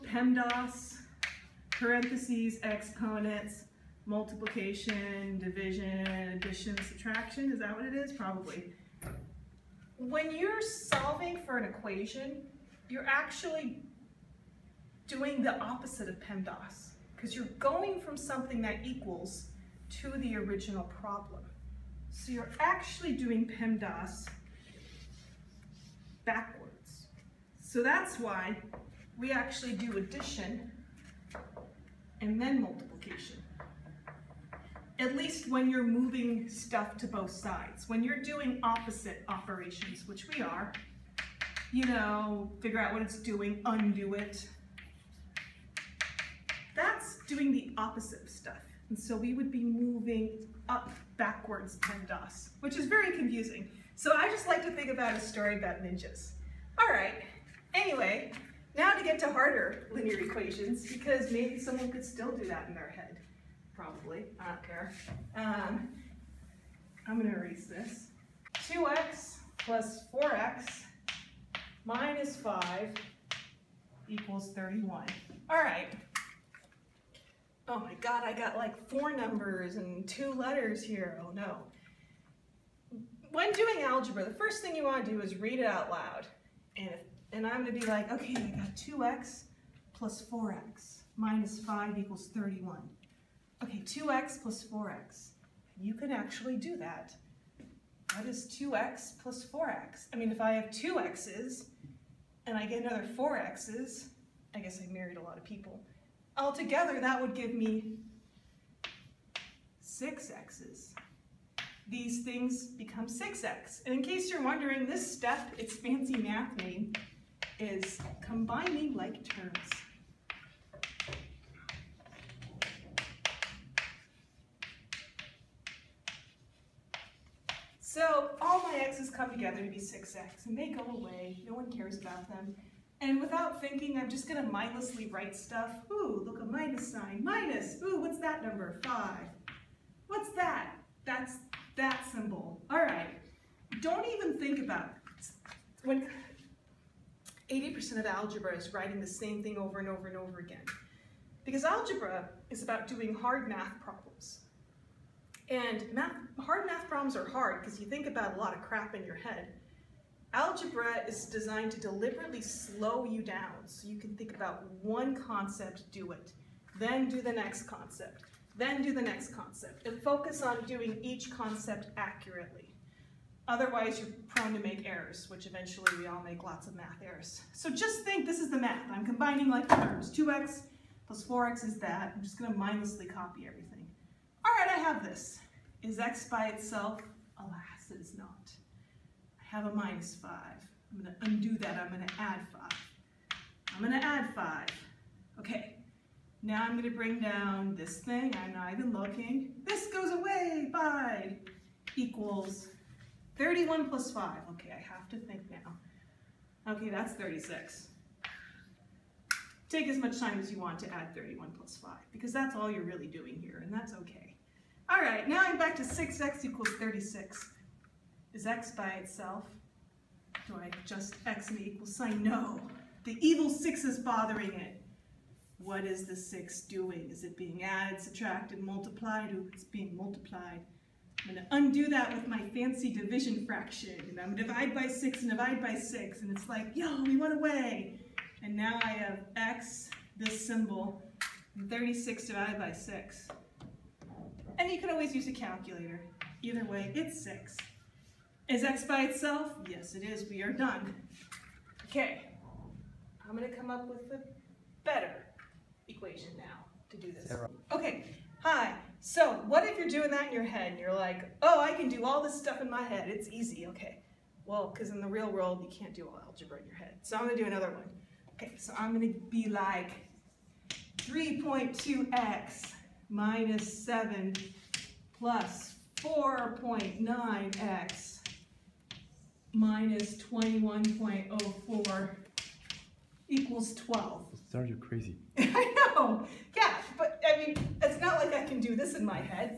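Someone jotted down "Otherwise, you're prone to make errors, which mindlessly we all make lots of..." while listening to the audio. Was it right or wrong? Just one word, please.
wrong.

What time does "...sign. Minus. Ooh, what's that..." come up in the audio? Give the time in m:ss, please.
2:16.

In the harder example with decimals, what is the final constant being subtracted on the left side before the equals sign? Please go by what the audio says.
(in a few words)
21.04.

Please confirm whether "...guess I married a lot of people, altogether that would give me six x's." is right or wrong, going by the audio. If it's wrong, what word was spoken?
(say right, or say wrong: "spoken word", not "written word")
right.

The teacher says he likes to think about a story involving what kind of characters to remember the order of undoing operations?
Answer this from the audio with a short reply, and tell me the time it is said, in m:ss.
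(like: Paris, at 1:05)
ninjas, at 0:55.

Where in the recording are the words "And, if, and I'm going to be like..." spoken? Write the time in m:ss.
1:26.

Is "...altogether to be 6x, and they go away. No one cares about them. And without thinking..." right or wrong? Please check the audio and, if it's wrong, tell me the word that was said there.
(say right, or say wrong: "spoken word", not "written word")
wrong: "together", not "altogether".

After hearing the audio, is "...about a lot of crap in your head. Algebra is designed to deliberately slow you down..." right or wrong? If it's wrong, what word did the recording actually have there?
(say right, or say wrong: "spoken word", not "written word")
right.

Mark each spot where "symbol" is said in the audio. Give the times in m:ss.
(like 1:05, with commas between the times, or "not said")
2:22, 4:00.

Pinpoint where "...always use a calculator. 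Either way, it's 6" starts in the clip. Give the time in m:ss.
4:04.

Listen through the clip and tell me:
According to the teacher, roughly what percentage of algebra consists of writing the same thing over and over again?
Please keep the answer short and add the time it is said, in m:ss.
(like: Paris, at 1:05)
80%, at 2:27.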